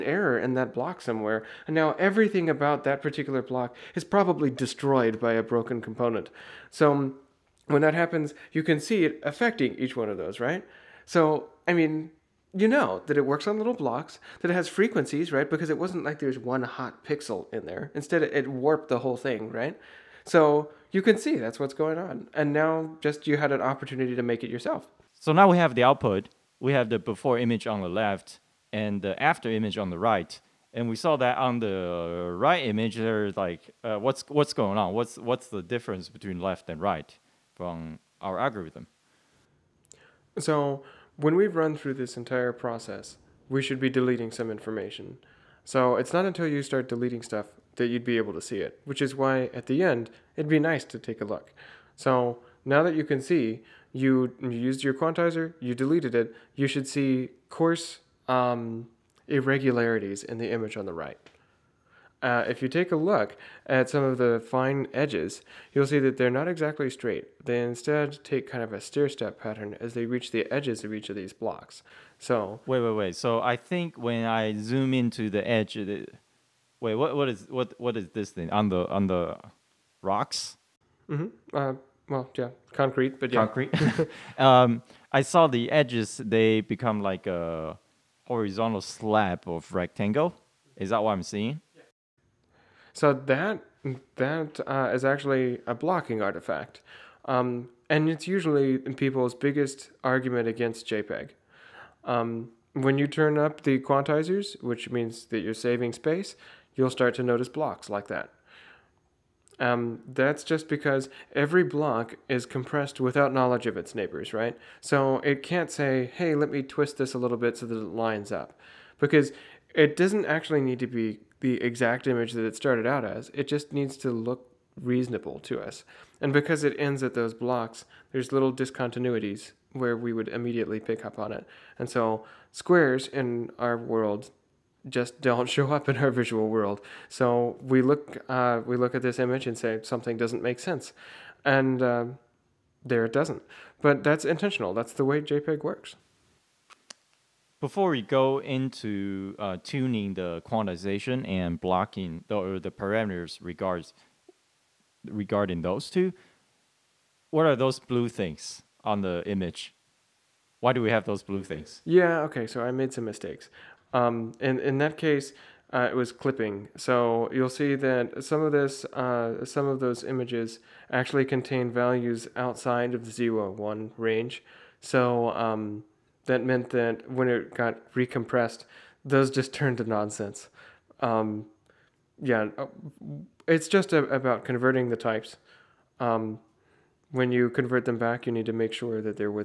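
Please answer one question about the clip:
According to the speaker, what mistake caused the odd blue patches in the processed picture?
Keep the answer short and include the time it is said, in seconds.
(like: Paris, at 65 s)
clipping, at 166 s.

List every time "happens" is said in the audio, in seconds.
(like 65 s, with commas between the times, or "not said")
7 s.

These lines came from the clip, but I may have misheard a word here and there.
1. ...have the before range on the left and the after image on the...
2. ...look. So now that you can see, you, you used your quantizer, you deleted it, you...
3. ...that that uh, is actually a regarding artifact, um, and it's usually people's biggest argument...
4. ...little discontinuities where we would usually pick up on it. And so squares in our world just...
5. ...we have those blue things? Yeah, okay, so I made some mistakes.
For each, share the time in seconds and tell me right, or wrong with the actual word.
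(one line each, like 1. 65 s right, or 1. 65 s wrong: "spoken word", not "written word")
1. 26 s wrong: "image", not "range"
2. 51 s right
3. 93 s wrong: "blocking", not "regarding"
4. 128 s wrong: "immediately", not "usually"
5. 160 s right.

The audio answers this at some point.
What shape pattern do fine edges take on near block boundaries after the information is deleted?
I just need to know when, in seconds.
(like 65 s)
68 s.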